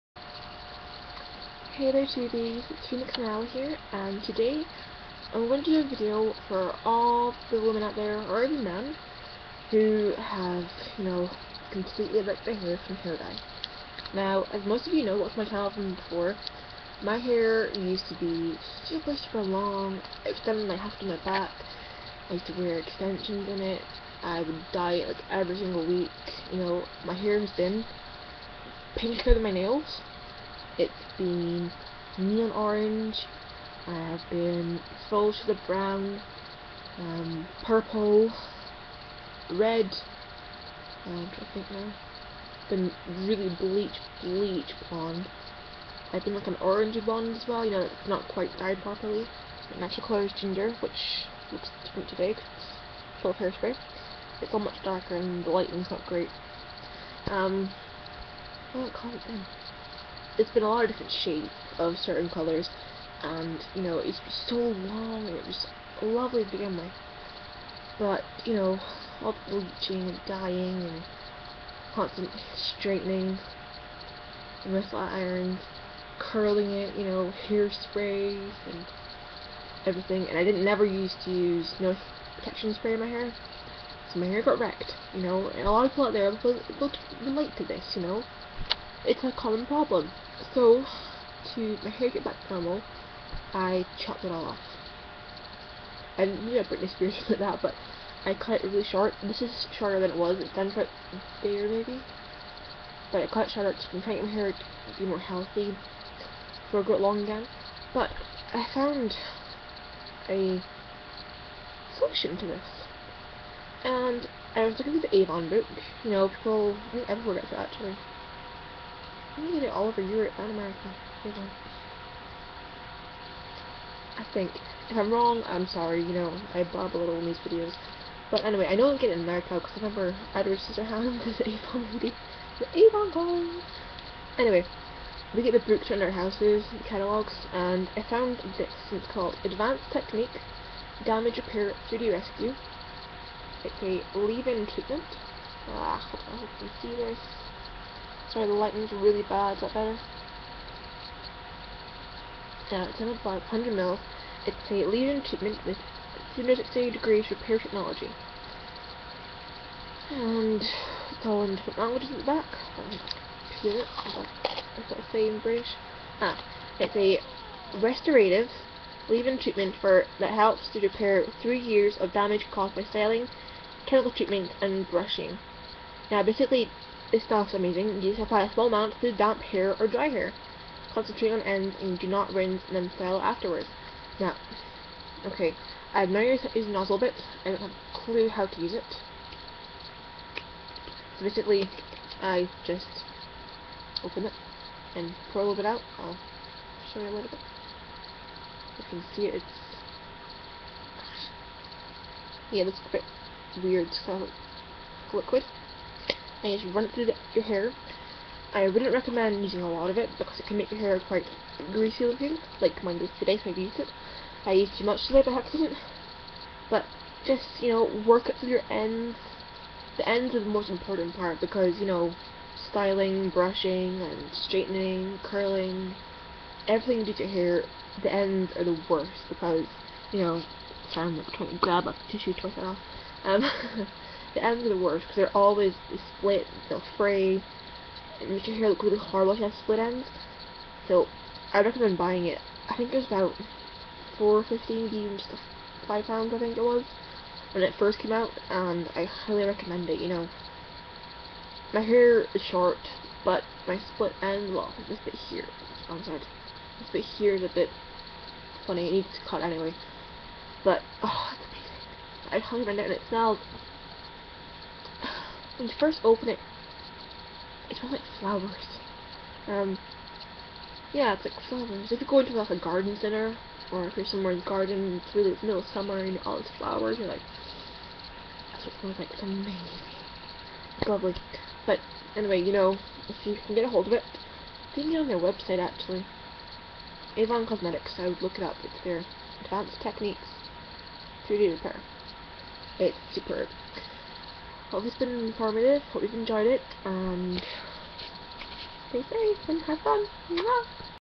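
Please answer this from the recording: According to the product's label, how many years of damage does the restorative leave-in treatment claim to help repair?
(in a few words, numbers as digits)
3.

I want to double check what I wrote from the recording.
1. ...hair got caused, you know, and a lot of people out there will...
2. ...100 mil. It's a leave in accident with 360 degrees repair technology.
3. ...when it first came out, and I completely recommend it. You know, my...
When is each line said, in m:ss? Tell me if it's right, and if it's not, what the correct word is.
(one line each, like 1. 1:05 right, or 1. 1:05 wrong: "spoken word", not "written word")
1. 1:24 wrong: "wrecked", not "caused"
2. 2:33 wrong: "treatment", not "accident"
3. 4:07 wrong: "highly", not "completely".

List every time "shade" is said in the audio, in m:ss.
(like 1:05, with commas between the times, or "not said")
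0:35, 1:01.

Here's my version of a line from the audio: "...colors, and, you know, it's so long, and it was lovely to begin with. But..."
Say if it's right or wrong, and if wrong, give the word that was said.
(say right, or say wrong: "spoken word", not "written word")
right.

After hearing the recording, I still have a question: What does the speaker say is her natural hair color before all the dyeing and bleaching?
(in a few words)
Ginger.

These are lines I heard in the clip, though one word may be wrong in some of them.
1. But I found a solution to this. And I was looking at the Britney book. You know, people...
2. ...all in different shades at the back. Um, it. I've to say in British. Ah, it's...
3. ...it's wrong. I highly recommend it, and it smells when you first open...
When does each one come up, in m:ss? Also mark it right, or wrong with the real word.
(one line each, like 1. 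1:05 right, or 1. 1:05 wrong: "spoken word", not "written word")
1. 1:47 wrong: "Avon", not "Britney"
2. 2:41 wrong: "languages", not "shades"
3. 4:21 wrong: "amazing", not "wrong".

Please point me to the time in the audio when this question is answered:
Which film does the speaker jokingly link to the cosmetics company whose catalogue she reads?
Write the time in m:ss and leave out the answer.
2:10.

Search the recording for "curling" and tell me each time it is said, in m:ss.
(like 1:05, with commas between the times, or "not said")
1:16, 3:45.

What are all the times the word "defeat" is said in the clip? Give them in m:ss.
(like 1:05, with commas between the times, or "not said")
not said.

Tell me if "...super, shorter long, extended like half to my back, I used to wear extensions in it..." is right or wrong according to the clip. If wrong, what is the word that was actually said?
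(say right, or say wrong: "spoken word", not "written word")
wrong: "super", not "shorter".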